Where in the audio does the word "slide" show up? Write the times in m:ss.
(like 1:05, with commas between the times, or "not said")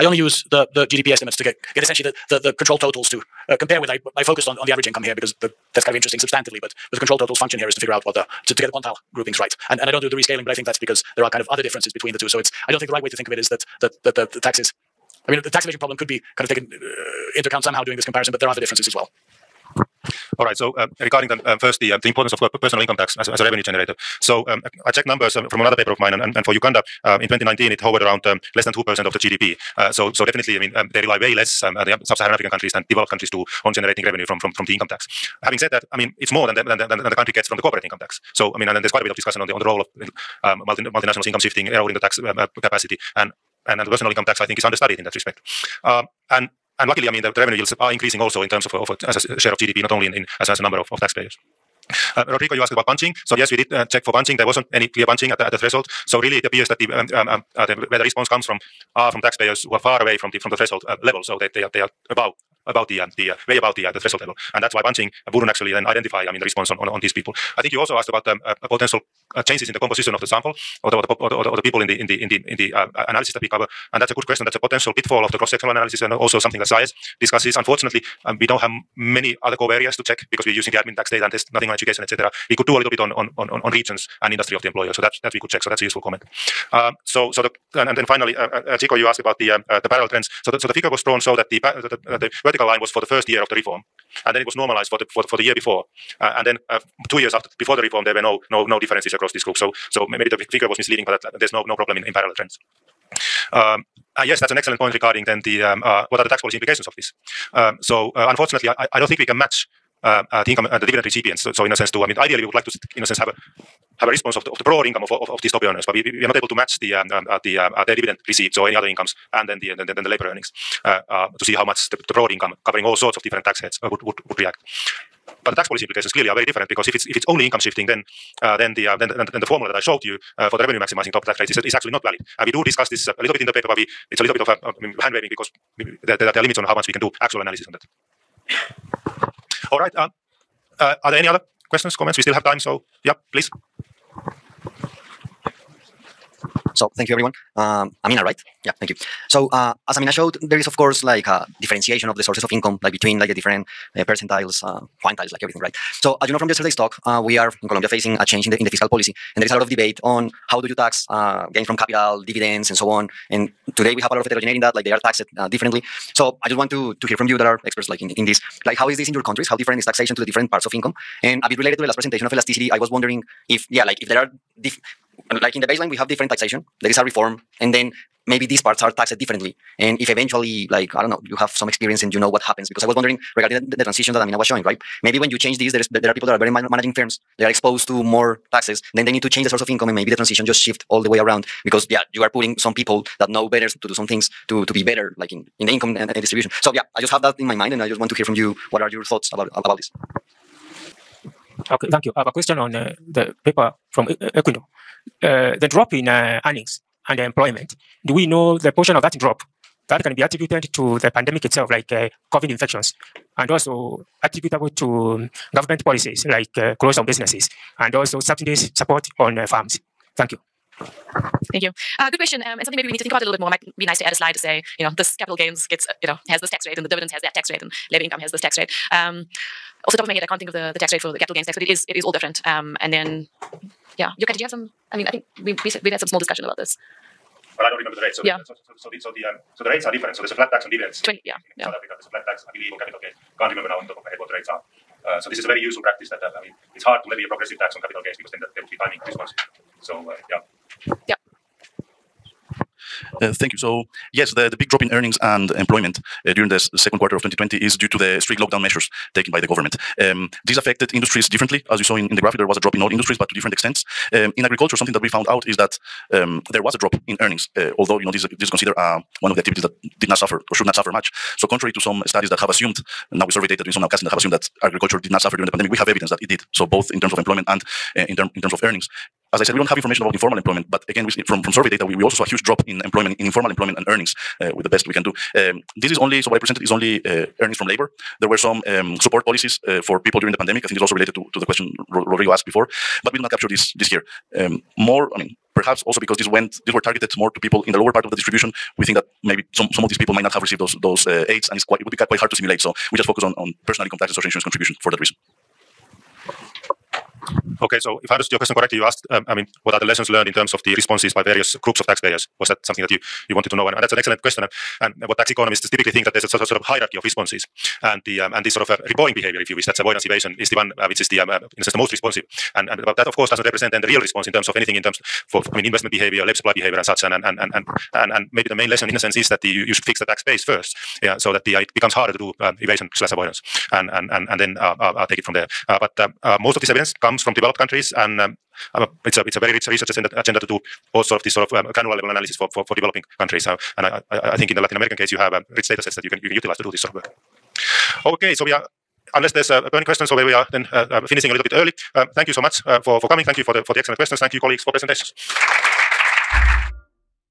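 3:44.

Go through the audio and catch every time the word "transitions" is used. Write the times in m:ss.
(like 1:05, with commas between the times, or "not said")
3:03, 3:10.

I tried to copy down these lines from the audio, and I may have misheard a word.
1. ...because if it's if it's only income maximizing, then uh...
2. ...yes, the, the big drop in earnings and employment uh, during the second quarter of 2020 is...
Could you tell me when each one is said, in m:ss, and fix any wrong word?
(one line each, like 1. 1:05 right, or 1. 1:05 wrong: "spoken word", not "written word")
1. 2:06 wrong: "shifting", not "maximizing"
2. 4:14 right.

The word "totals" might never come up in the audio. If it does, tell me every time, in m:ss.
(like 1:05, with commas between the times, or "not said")
0:02, 0:07.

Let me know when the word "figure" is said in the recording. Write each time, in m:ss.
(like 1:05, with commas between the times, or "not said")
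0:07, 1:30, 1:40.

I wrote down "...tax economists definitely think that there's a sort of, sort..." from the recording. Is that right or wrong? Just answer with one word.
wrong.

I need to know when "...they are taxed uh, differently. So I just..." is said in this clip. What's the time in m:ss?
2:44.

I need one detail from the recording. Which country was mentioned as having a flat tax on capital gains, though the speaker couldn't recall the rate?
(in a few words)
South Africa.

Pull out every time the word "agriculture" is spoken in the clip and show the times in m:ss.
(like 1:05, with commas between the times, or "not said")
4:24, 4:34.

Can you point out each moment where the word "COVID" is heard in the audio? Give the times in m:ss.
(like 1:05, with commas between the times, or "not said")
3:32.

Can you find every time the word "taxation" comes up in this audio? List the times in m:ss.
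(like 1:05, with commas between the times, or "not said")
2:49, 2:56.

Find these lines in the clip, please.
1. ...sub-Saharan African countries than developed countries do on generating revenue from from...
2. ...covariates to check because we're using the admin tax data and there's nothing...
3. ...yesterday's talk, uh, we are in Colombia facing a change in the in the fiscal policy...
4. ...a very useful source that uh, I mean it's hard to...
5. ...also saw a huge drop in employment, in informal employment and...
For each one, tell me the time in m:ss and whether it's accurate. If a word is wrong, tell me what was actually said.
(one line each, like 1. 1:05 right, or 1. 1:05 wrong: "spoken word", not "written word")
1. 0:32 right
2. 1:19 right
3. 2:36 right
4. 4:05 wrong: "practice", not "source"
5. 4:42 right.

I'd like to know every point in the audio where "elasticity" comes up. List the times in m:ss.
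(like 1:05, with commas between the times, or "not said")
2:52.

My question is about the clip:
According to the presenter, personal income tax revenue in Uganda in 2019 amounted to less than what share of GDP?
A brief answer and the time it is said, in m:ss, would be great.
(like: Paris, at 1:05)
2 percent, at 0:28.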